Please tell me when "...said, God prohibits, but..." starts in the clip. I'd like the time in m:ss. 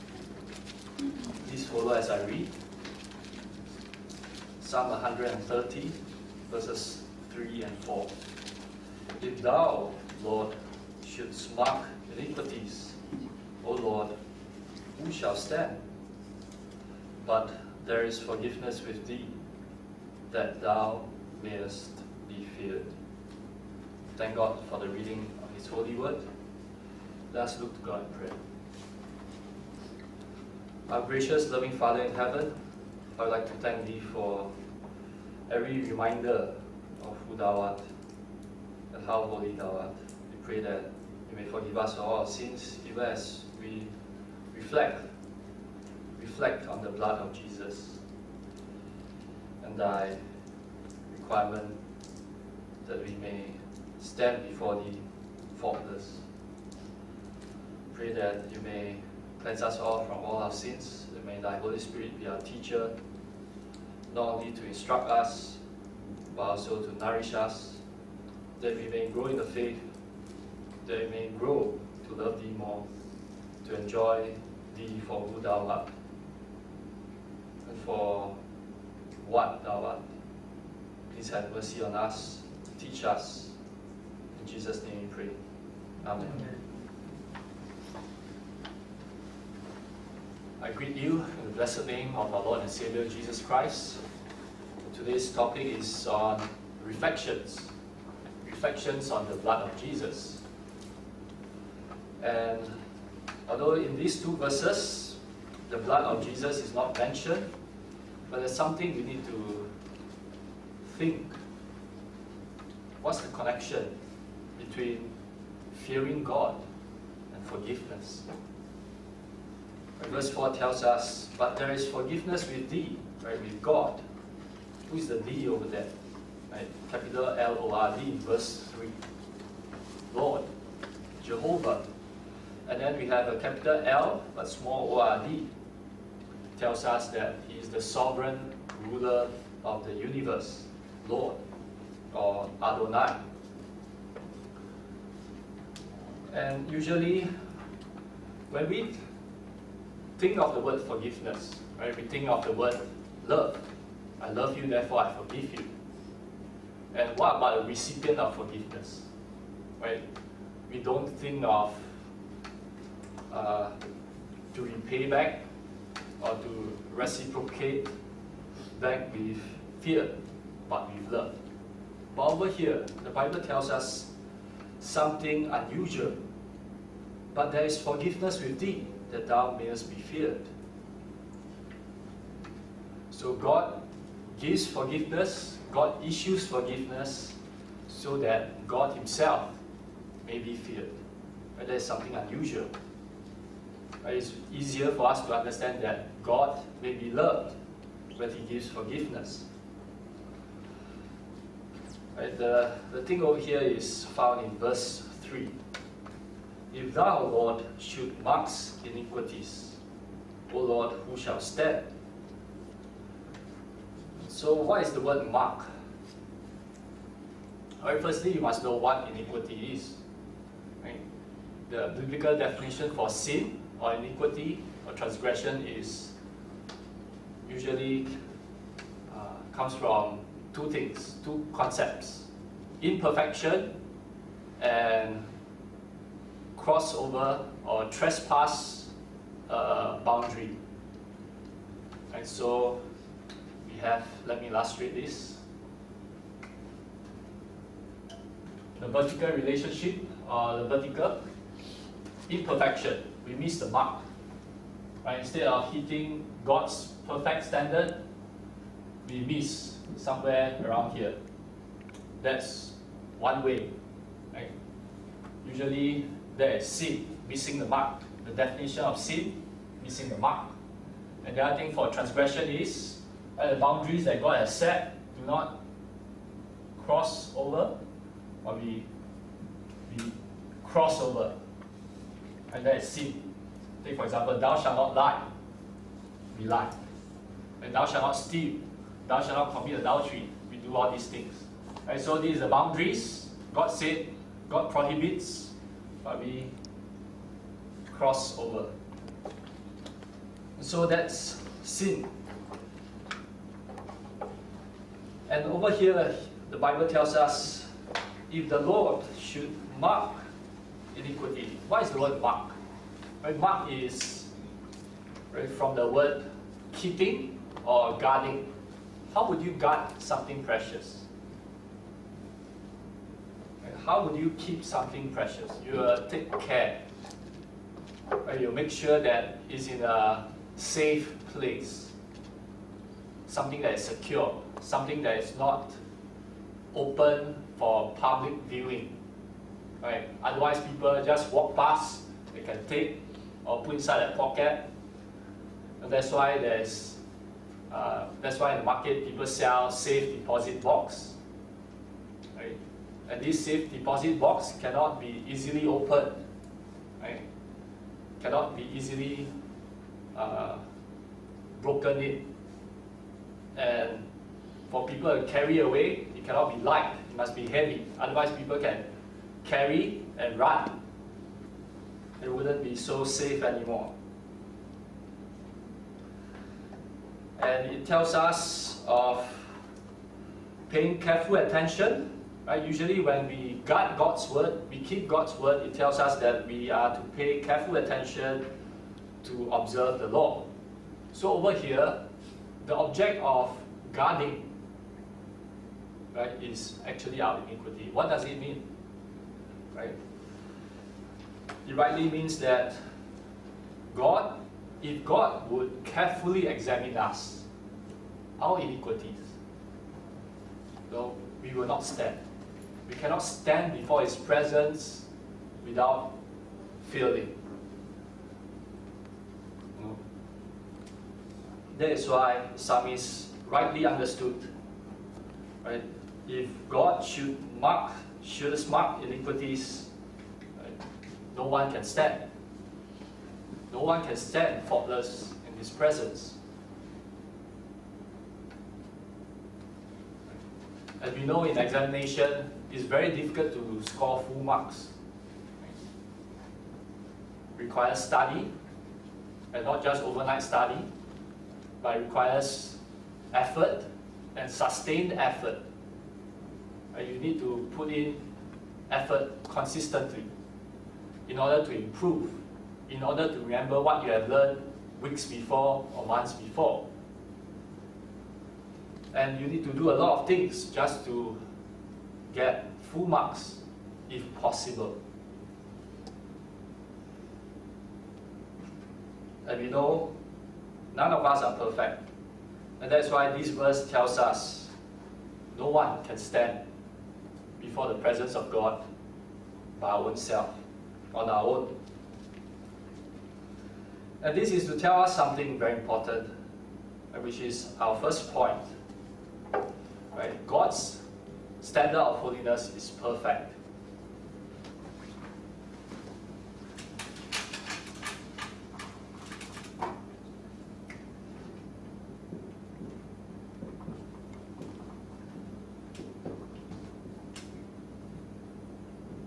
4:53.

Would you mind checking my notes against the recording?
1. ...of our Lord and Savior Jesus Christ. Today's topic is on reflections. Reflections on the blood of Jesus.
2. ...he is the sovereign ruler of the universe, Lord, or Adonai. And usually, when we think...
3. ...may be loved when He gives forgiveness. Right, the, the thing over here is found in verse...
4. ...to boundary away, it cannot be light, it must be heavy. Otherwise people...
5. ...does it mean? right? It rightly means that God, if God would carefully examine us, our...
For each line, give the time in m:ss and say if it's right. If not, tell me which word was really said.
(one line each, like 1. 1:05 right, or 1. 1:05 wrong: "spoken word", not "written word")
1. 1:32 right
2. 2:17 right
3. 3:16 right
4. 6:05 wrong: "carry", not "boundary"
5. 6:38 right.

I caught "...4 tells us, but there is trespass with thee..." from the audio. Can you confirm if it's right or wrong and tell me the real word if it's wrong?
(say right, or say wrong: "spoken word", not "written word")
wrong: "forgiveness", not "trespass".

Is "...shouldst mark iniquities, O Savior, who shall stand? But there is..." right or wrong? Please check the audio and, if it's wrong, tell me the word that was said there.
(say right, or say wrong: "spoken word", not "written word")
wrong: "Lord", not "Savior".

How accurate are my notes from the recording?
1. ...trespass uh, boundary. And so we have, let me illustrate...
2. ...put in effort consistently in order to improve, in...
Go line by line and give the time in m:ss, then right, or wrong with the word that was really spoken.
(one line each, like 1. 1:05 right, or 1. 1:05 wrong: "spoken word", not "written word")
1. 3:57 right
2. 7:37 right.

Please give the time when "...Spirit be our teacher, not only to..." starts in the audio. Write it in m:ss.
1:01.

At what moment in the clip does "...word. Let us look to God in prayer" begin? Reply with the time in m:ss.
0:25.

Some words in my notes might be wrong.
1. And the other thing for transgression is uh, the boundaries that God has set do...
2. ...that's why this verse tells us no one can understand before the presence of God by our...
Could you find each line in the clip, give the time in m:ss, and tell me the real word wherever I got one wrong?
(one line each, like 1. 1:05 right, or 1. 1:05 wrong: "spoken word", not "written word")
1. 4:31 right
2. 8:02 wrong: "stand", not "understand".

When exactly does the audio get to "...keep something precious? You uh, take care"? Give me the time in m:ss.
5:24.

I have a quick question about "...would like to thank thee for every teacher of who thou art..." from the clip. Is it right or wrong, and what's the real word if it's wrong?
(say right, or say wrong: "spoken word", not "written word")
wrong: "reminder", not "teacher".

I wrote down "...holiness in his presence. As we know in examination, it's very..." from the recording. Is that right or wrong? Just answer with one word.
wrong.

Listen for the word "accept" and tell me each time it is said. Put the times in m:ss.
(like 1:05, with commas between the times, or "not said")
not said.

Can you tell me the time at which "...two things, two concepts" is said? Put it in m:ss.
3:50.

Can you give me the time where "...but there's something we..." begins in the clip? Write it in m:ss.
1:48.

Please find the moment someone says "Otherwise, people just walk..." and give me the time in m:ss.
5:40.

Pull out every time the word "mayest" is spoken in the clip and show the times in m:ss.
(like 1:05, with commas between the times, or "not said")
0:21, 2:59.